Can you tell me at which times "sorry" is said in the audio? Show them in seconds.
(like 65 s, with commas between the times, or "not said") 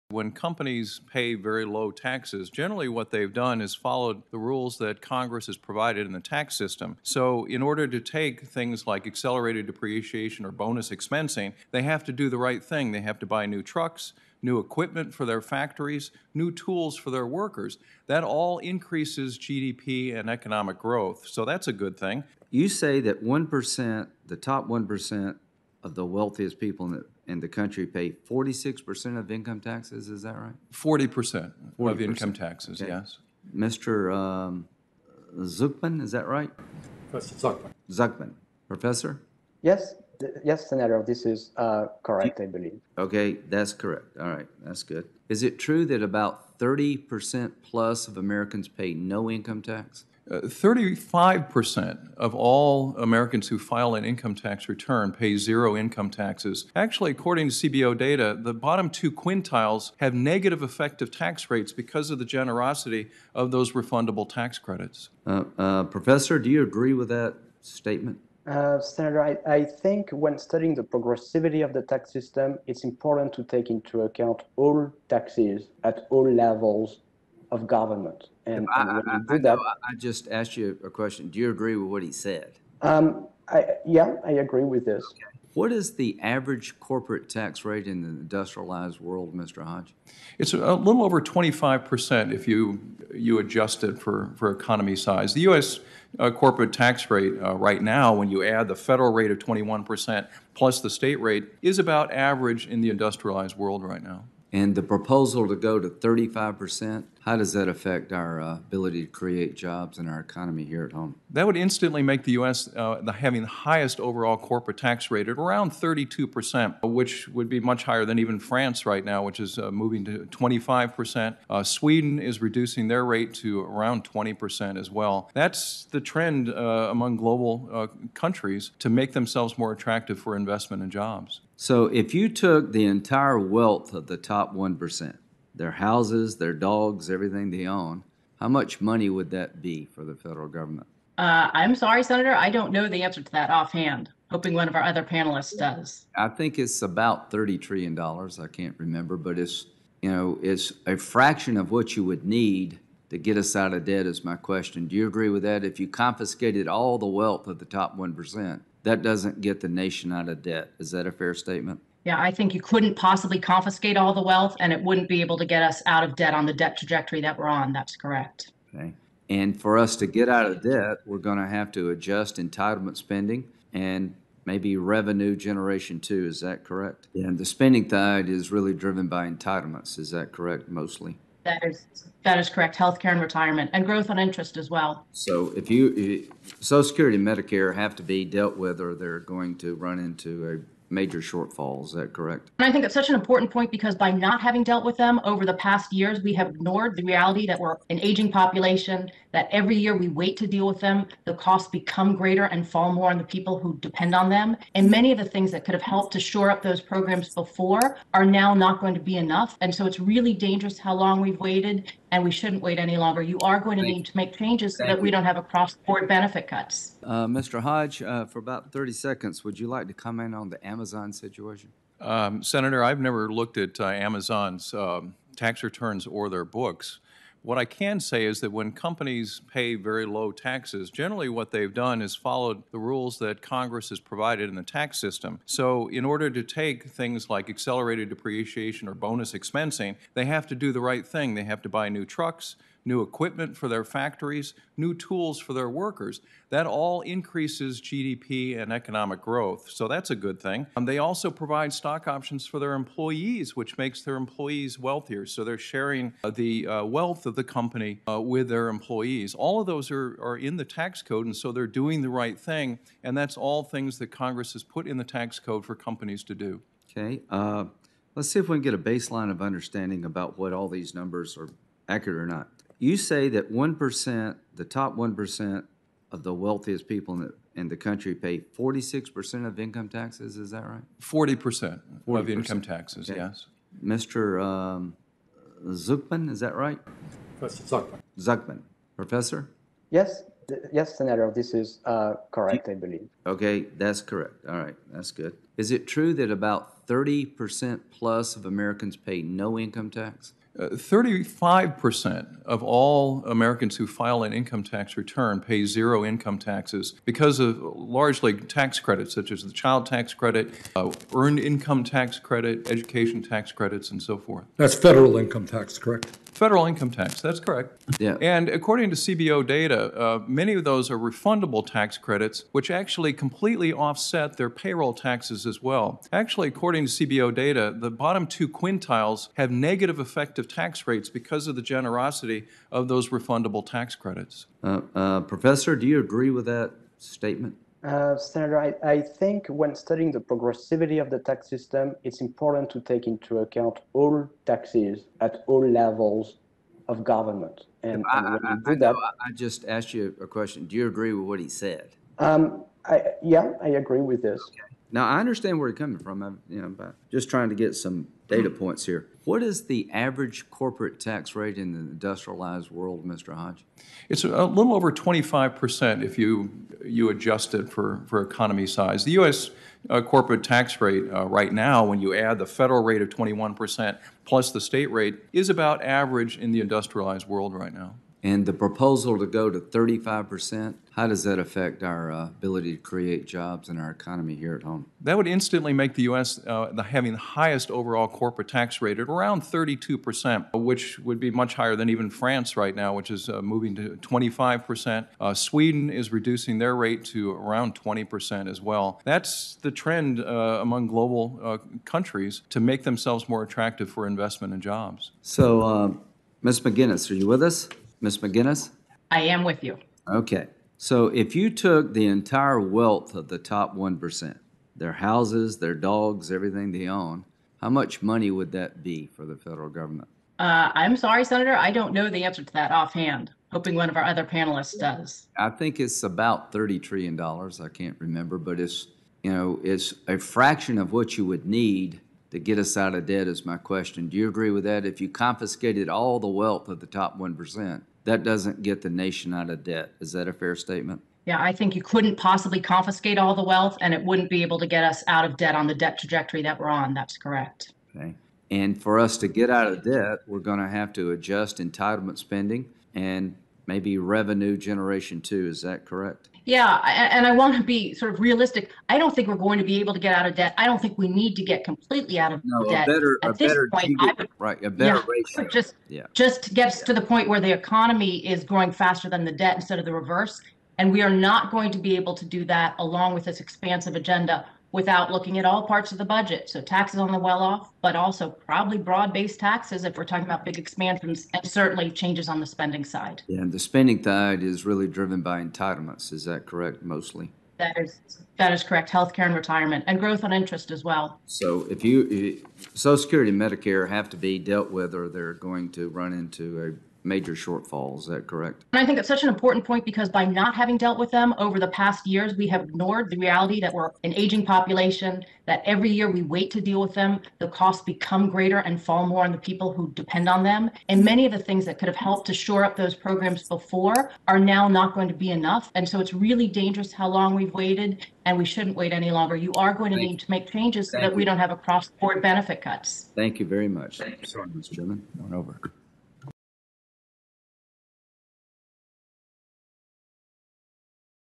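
141 s, 420 s, 523 s.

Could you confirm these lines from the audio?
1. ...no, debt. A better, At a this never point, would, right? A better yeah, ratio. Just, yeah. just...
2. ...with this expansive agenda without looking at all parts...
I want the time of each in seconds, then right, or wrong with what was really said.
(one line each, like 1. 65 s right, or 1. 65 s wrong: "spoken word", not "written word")
1. 462 s wrong: "better", not "never"
2. 473 s right.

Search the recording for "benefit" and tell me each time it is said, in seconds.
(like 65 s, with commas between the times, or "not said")
216 s, 522 s.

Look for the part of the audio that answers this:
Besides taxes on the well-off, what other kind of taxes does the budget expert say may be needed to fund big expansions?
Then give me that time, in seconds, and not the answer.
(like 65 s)
478 s.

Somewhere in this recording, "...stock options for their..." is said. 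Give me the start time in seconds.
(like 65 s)
251 s.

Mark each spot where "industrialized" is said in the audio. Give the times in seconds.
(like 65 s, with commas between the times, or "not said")
88 s, 102 s, 361 s, 376 s.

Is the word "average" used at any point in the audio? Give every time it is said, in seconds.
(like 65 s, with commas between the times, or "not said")
86 s, 102 s, 359 s, 375 s.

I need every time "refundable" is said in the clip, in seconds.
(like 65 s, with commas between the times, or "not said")
63 s, 320 s, 333 s.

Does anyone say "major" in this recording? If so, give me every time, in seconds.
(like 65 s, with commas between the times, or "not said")
190 s, 497 s.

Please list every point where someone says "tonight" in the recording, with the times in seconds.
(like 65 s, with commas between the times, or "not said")
not said.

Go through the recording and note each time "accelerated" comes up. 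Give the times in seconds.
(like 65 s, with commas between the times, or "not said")
9 s, 237 s.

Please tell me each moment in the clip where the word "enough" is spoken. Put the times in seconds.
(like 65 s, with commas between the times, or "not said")
209 s, 515 s.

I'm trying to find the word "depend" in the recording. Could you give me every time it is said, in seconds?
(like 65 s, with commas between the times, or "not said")
203 s, 509 s.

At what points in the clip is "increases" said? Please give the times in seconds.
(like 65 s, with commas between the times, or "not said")
18 s, 247 s.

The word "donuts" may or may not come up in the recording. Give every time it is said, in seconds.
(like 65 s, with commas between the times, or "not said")
not said.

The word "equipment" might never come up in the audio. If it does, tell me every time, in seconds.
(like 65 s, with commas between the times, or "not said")
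14 s, 243 s.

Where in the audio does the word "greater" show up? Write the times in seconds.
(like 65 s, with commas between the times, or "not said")
202 s, 508 s.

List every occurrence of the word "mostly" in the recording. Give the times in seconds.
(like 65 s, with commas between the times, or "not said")
180 s, 486 s.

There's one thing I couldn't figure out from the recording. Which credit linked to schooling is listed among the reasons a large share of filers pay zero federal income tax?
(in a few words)
education tax credits.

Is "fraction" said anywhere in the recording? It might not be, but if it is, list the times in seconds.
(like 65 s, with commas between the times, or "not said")
150 s, 430 s.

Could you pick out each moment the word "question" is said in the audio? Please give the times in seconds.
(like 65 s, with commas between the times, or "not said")
80 s, 154 s, 350 s, 433 s.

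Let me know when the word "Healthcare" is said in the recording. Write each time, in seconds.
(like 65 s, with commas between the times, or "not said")
182 s, 488 s.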